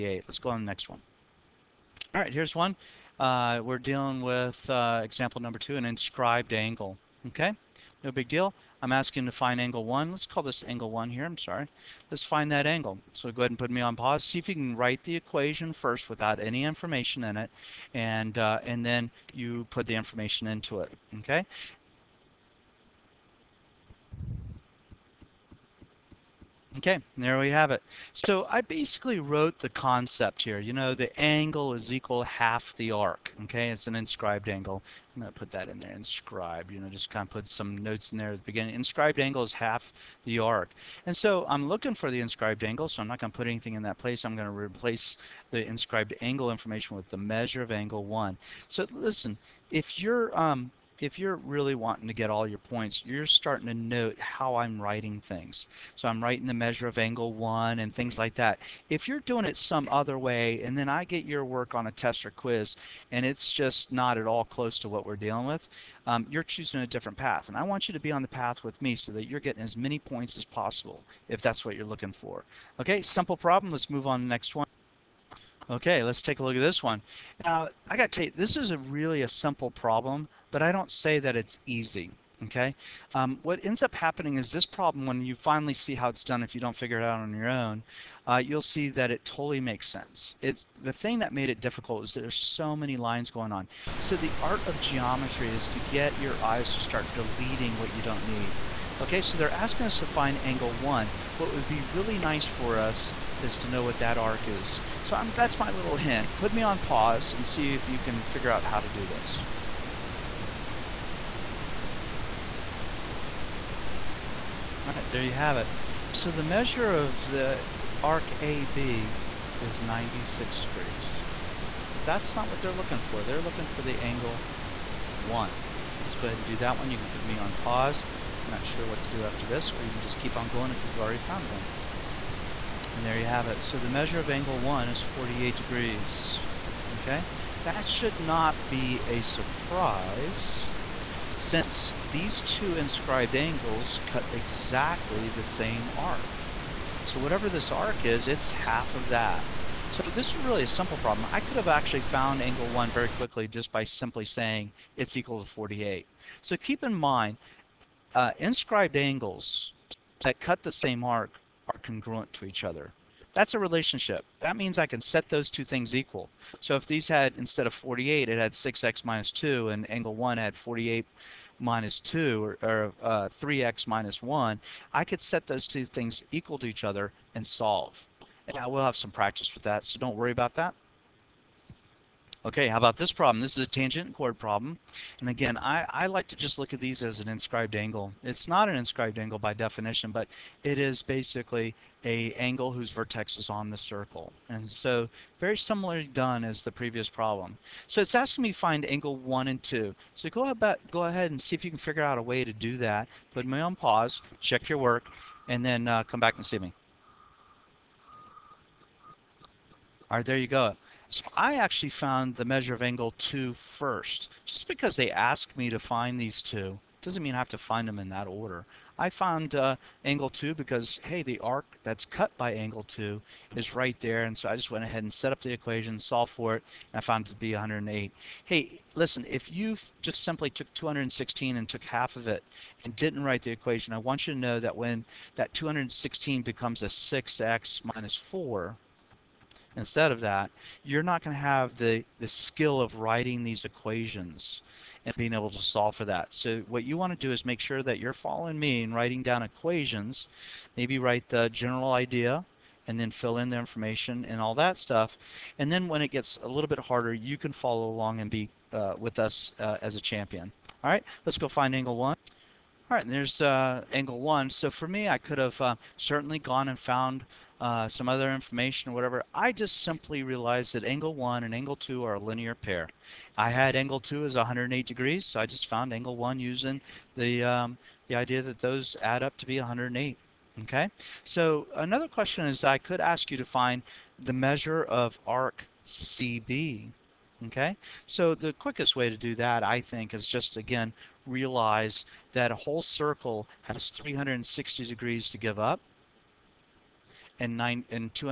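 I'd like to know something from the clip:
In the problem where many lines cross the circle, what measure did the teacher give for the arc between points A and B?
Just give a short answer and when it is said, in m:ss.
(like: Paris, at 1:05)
96 degrees, at 1:59.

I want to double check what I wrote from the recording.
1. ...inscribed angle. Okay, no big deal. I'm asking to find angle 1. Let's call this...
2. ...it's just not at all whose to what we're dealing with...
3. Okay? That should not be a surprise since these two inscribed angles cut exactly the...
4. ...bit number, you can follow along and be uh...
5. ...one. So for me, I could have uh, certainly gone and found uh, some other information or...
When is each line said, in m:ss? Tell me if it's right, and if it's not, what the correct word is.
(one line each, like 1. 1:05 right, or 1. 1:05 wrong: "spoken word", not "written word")
1. 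0:05 right
2. 1:03 wrong: "close", not "whose"
3. 2:16 right
4. 4:16 wrong: "harder", not "number"
5. 4:24 right.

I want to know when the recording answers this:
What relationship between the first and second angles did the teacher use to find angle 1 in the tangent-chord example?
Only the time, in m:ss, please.
4:32.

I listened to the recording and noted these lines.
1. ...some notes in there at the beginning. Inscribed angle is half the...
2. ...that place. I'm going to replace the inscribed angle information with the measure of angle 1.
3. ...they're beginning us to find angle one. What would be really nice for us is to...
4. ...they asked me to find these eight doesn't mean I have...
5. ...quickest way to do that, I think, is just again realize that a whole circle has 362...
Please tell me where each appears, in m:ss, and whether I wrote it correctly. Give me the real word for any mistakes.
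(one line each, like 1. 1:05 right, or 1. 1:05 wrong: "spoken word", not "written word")
1. 0:37 right
2. 0:43 right
3. 1:39 wrong: "asking", not "beginning"
4. 3:34 wrong: "two", not "eight"
5. 4:48 wrong: "360", not "362".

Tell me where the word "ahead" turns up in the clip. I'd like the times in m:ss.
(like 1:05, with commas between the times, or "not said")
0:13, 2:06, 3:21, 3:44.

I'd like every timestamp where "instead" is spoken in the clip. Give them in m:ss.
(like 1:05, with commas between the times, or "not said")
2:47, 3:59.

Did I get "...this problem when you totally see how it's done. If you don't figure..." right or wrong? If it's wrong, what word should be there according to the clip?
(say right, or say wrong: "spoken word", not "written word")
wrong: "finally", not "totally".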